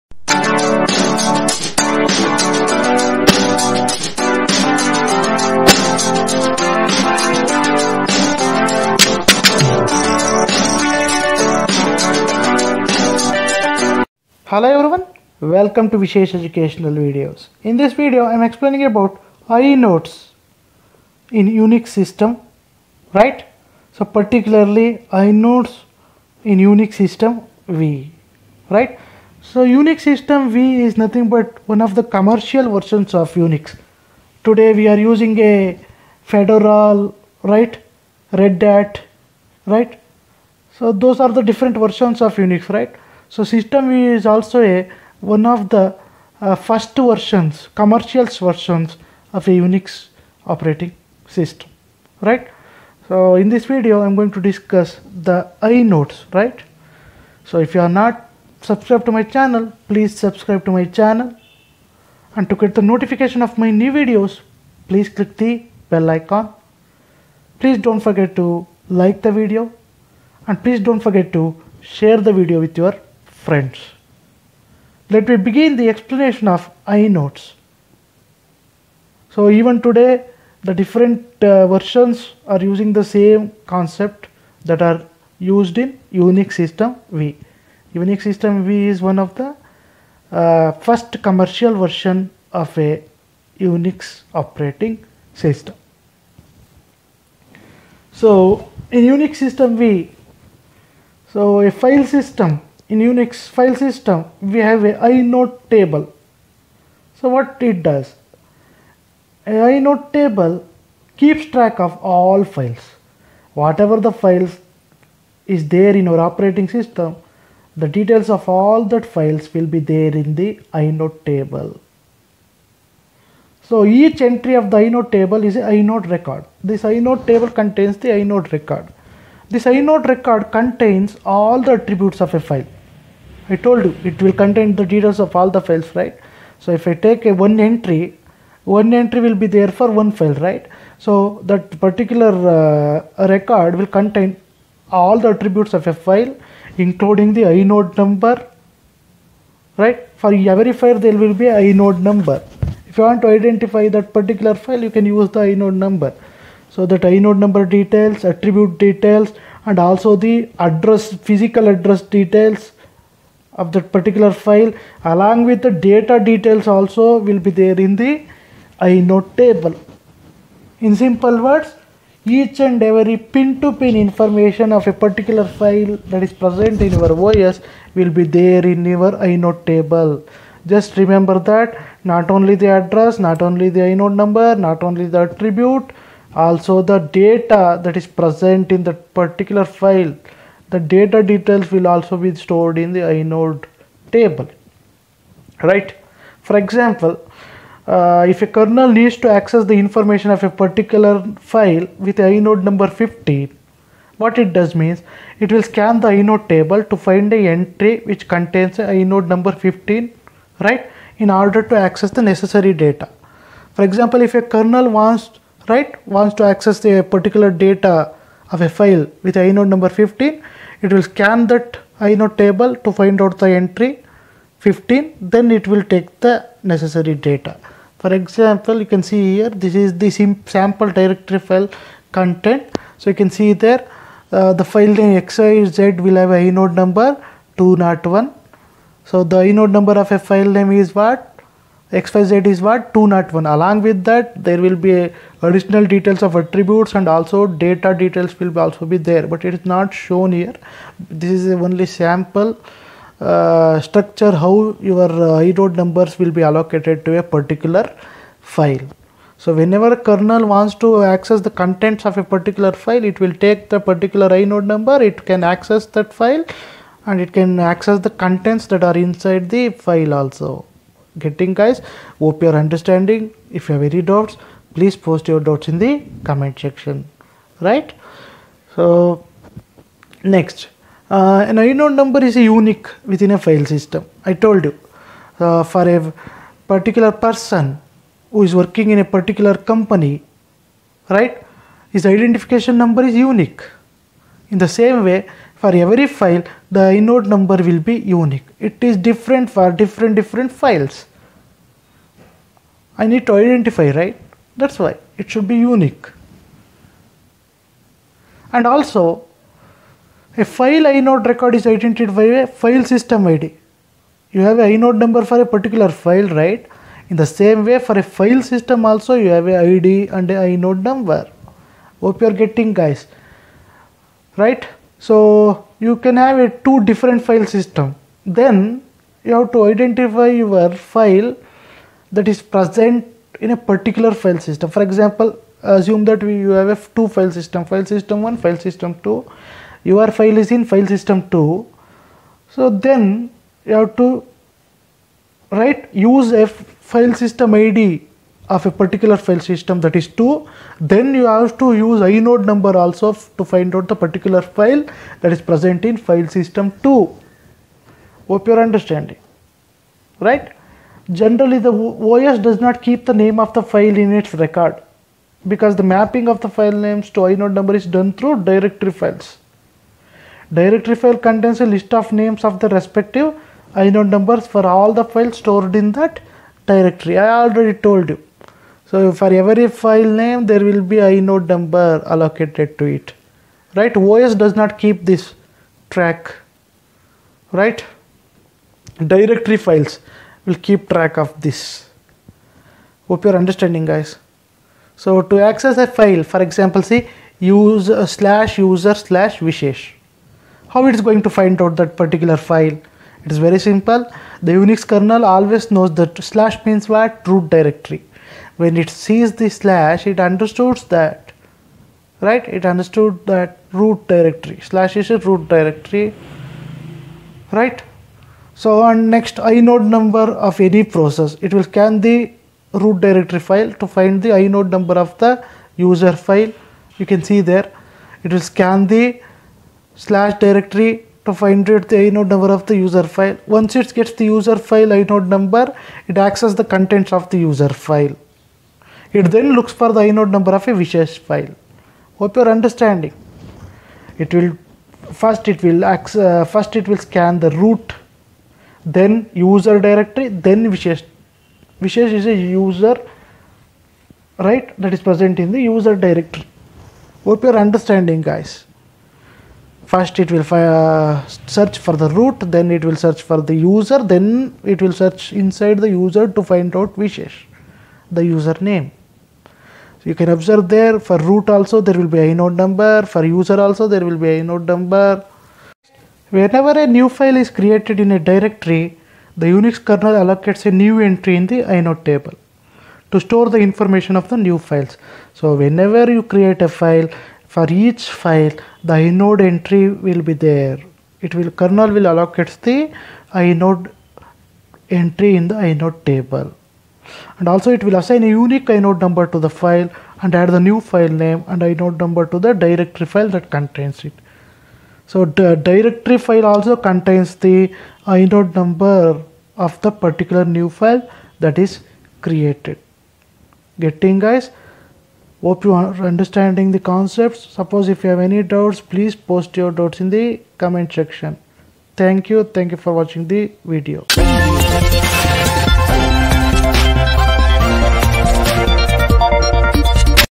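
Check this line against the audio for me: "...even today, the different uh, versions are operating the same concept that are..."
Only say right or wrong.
wrong.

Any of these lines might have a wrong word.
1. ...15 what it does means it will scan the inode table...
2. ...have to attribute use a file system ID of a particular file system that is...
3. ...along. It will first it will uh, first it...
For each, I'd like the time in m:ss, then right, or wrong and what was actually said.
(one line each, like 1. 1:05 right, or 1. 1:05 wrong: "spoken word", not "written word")
1. 3:23 right
2. 5:43 wrong: "write", not "attribute"
3. 7:22 wrong: "understanding", not "along".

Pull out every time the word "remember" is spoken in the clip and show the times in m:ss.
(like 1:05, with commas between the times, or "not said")
3:01.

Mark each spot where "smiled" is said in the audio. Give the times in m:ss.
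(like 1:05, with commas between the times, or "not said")
not said.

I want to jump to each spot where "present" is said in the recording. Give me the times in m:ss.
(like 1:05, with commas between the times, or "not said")
2:56, 3:08, 5:32, 5:55, 7:35.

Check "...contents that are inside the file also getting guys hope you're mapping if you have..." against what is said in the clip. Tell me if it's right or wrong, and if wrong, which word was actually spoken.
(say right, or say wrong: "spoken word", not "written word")
wrong: "understanding", not "mapping".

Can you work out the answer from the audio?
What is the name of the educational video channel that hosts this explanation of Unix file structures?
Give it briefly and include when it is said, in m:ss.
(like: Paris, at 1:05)
Vishesh Educational Videos, at 0:15.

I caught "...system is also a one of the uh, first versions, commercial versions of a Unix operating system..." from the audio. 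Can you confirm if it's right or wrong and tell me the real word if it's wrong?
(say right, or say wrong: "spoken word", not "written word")
right.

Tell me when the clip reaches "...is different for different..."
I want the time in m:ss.
4:58.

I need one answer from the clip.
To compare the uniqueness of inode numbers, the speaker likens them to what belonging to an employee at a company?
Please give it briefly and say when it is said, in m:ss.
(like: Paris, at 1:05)
identification number, at 4:52.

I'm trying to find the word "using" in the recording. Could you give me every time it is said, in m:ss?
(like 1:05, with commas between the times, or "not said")
0:34, 1:22.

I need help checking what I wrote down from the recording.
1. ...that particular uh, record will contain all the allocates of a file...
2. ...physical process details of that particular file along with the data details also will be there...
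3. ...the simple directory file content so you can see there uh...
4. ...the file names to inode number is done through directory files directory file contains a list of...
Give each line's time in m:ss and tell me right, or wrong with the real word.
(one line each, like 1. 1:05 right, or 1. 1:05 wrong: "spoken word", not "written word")
1. 2:21 wrong: "attributes", not "allocates"
2. 2:41 wrong: "address", not "process"
3. 3:50 wrong: "sample", not "simple"
4. 6:06 right.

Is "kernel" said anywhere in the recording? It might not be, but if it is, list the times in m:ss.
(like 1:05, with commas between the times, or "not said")
3:18, 3:34, 4:19, 6:44, 7:59, 8:11.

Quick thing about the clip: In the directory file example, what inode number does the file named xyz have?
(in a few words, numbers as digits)
201.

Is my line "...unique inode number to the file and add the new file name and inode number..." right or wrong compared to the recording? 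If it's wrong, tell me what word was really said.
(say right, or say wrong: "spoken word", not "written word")
right.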